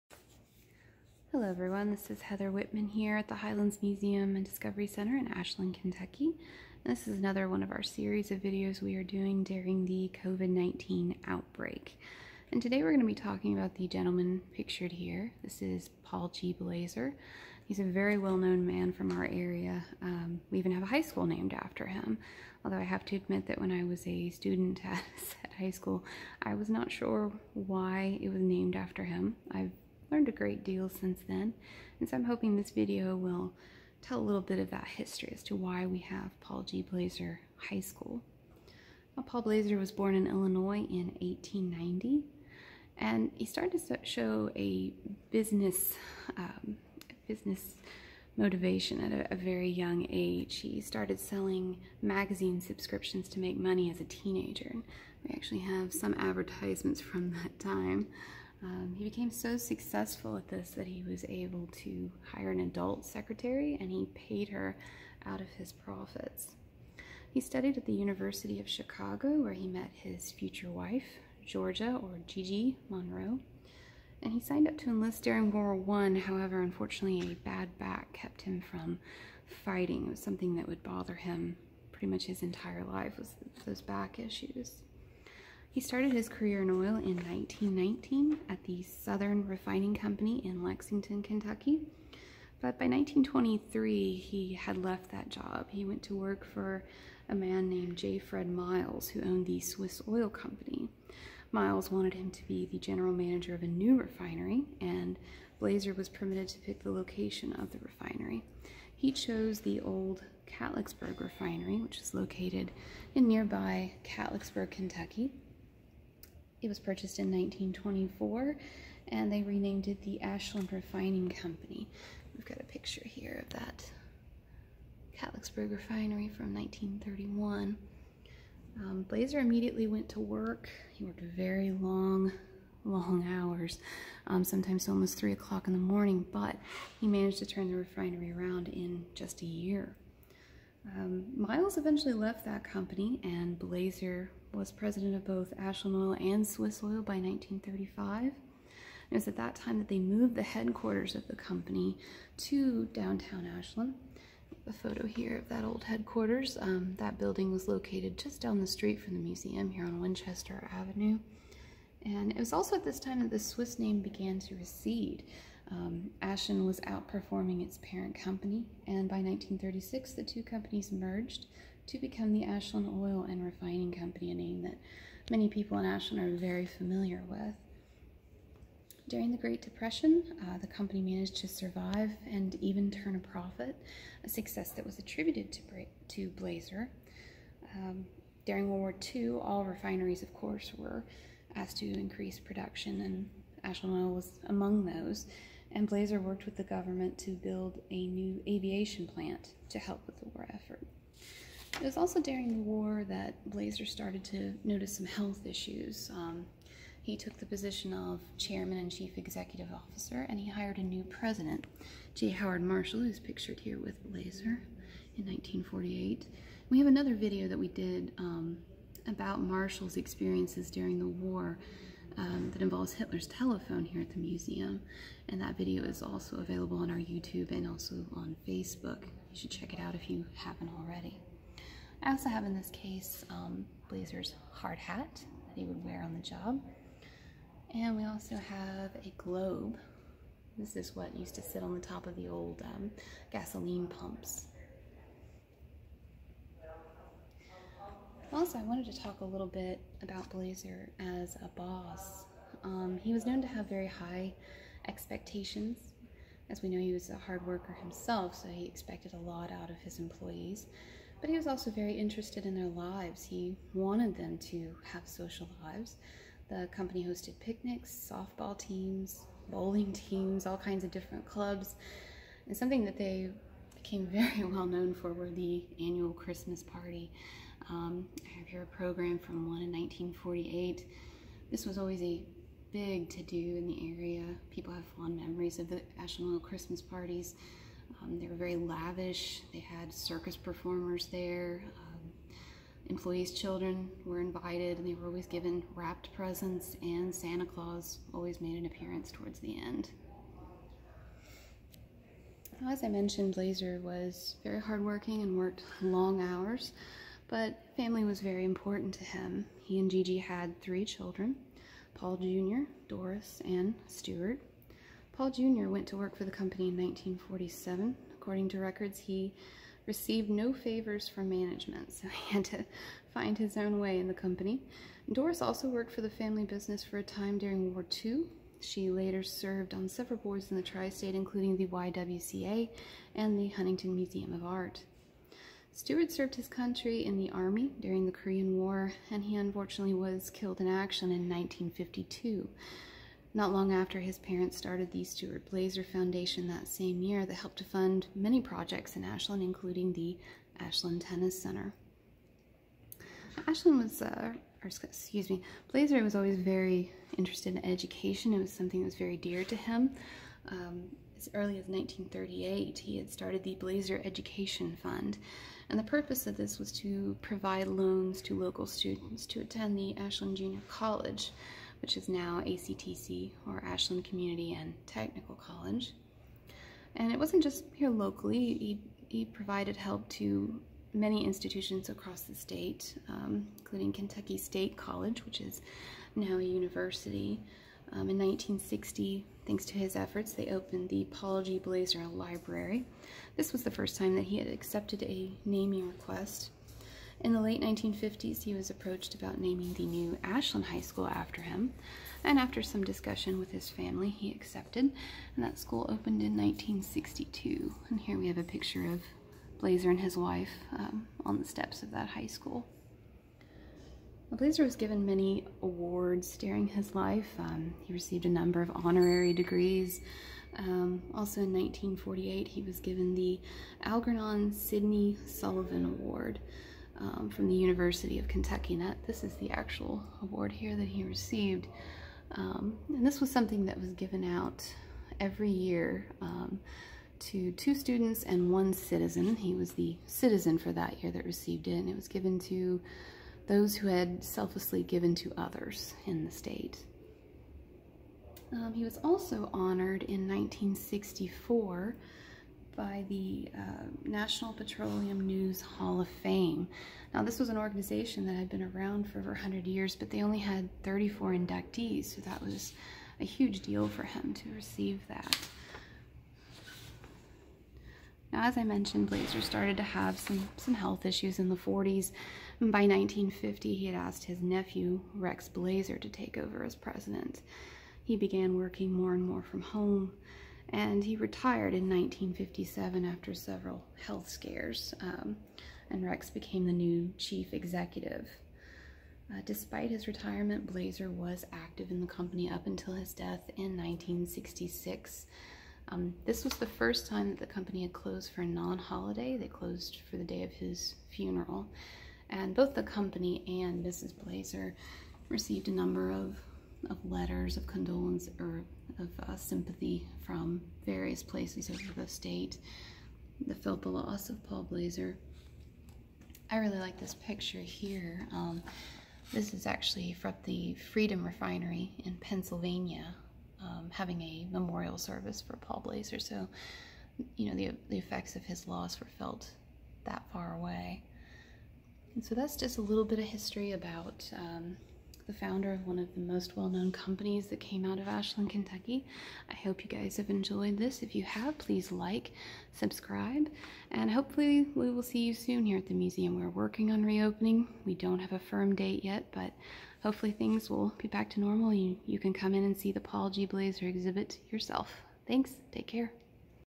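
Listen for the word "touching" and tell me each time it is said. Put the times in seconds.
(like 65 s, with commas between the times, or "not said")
not said.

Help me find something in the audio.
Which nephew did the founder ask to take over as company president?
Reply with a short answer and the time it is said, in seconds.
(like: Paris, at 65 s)
Rex Blazer, at 475 s.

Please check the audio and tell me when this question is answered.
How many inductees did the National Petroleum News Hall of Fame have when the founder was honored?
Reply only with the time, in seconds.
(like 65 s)
460 s.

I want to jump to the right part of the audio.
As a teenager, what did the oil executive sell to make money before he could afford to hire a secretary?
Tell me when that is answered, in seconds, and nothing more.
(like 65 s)
52 s.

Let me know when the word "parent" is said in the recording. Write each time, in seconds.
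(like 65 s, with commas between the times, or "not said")
167 s, 344 s.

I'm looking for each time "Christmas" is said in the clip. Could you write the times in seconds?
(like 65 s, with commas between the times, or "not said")
276 s, 286 s.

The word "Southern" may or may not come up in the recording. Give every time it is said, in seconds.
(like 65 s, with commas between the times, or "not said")
88 s.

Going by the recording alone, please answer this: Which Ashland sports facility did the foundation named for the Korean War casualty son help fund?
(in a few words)
Ashland Tennis Center.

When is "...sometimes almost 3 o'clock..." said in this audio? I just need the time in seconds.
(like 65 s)
134 s.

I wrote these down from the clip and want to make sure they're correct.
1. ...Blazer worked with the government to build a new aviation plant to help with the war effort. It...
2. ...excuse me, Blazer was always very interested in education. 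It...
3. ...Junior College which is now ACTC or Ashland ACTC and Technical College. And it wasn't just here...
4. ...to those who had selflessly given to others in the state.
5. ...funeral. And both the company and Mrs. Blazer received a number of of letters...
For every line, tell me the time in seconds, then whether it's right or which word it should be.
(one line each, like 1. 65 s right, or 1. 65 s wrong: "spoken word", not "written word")
1. 195 s right
2. 354 s right
3. 370 s wrong: "Community", not "ACTC"
4. 442 s right
5. 501 s right.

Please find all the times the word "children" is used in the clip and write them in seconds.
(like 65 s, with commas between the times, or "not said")
293 s, 310 s.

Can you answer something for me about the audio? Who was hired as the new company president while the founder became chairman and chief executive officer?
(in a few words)
J. Howard Marshall.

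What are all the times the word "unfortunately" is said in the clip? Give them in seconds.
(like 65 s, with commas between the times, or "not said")
76 s, 339 s.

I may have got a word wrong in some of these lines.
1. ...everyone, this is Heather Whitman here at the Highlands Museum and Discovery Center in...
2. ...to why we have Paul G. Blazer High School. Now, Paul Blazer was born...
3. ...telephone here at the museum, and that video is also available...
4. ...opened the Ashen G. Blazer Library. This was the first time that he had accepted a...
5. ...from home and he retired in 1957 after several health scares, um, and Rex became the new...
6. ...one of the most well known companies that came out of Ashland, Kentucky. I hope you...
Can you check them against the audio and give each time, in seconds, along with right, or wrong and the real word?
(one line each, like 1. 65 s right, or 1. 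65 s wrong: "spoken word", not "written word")
1. 1 s right
2. 35 s right
3. 223 s right
4. 390 s wrong: "Paul", not "Ashen"
5. 479 s right
6. 535 s right.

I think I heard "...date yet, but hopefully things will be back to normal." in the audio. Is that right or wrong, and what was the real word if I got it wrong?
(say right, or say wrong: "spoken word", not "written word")
right.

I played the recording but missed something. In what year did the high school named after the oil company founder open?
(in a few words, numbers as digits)
1962.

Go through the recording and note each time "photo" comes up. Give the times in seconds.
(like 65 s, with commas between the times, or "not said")
154 s.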